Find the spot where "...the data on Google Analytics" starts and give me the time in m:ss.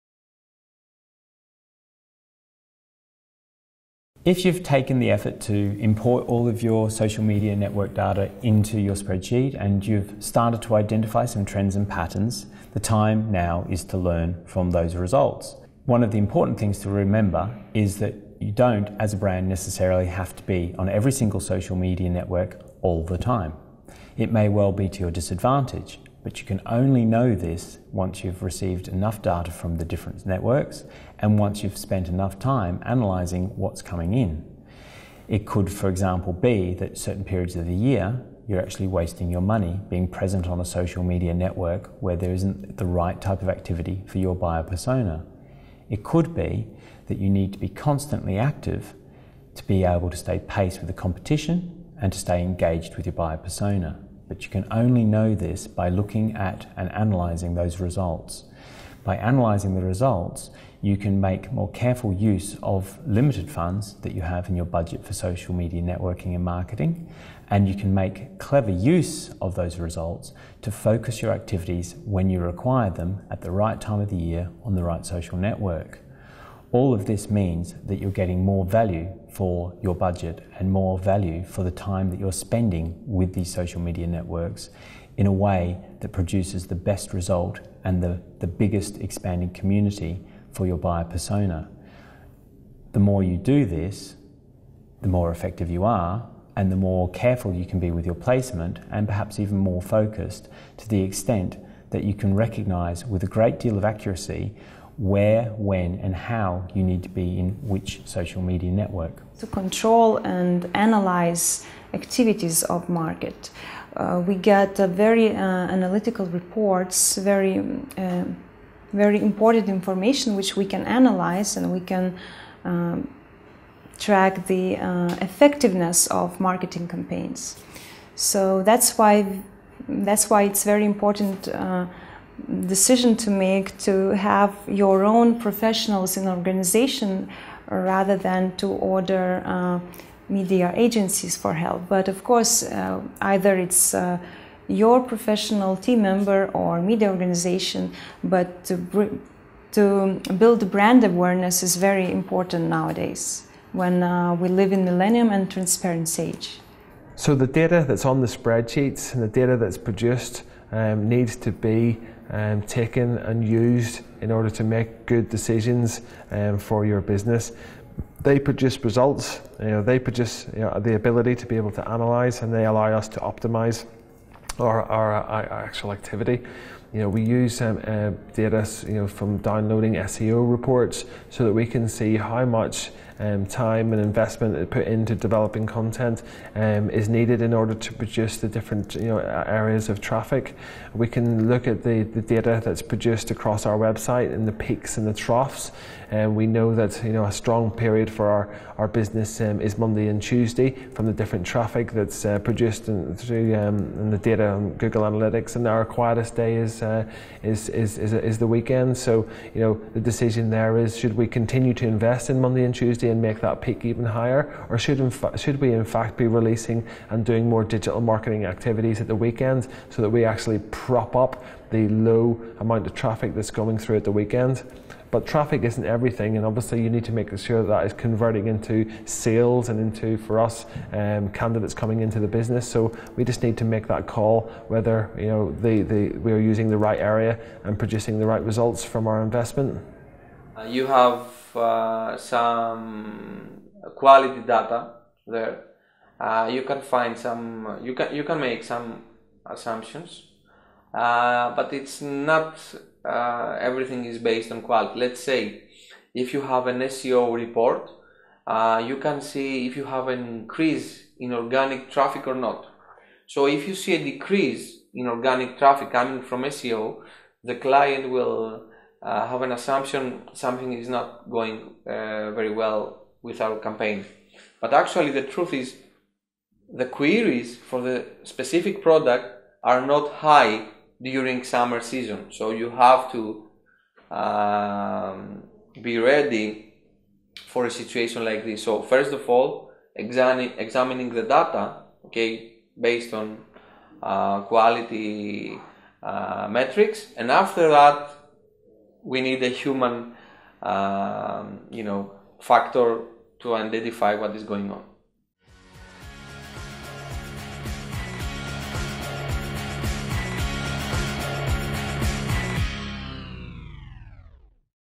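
3:24.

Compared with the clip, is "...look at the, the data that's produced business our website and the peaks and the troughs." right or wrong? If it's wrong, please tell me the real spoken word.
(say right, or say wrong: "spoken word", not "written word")
wrong: "across", not "business".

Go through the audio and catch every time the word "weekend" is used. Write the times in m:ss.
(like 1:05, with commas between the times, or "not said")
3:28, 3:39, 3:44.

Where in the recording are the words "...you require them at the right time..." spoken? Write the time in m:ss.
1:12.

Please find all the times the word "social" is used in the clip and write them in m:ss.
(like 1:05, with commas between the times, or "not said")
0:06, 0:21, 0:40, 1:05, 1:15, 1:23, 1:48.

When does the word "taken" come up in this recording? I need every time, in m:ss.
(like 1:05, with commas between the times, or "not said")
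0:04, 2:42.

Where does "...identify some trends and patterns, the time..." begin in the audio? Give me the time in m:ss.
0:10.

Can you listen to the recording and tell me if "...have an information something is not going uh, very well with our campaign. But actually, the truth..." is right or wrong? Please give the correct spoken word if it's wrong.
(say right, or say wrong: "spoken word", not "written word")
wrong: "assumption", not "information".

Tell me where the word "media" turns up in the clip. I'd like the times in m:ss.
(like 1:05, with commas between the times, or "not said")
0:07, 0:21, 0:41, 1:05, 1:23, 1:48, 2:20, 2:26.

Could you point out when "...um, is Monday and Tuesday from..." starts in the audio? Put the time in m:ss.
3:19.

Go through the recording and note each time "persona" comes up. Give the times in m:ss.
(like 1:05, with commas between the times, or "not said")
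0:44, 0:53, 1:31.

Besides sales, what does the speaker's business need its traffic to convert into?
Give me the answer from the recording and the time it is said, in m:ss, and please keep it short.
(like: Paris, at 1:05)
Candidates, at 3:51.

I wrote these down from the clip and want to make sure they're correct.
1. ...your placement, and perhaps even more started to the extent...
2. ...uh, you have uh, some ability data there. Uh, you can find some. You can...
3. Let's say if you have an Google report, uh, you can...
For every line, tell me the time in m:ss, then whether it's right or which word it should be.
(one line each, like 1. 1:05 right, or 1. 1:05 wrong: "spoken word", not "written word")
1. 1:38 wrong: "focused", not "started"
2. 4:00 wrong: "quality", not "ability"
3. 4:14 wrong: "SEO", not "Google".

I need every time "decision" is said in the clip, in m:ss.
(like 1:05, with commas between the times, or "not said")
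2:12, 2:45, 3:30.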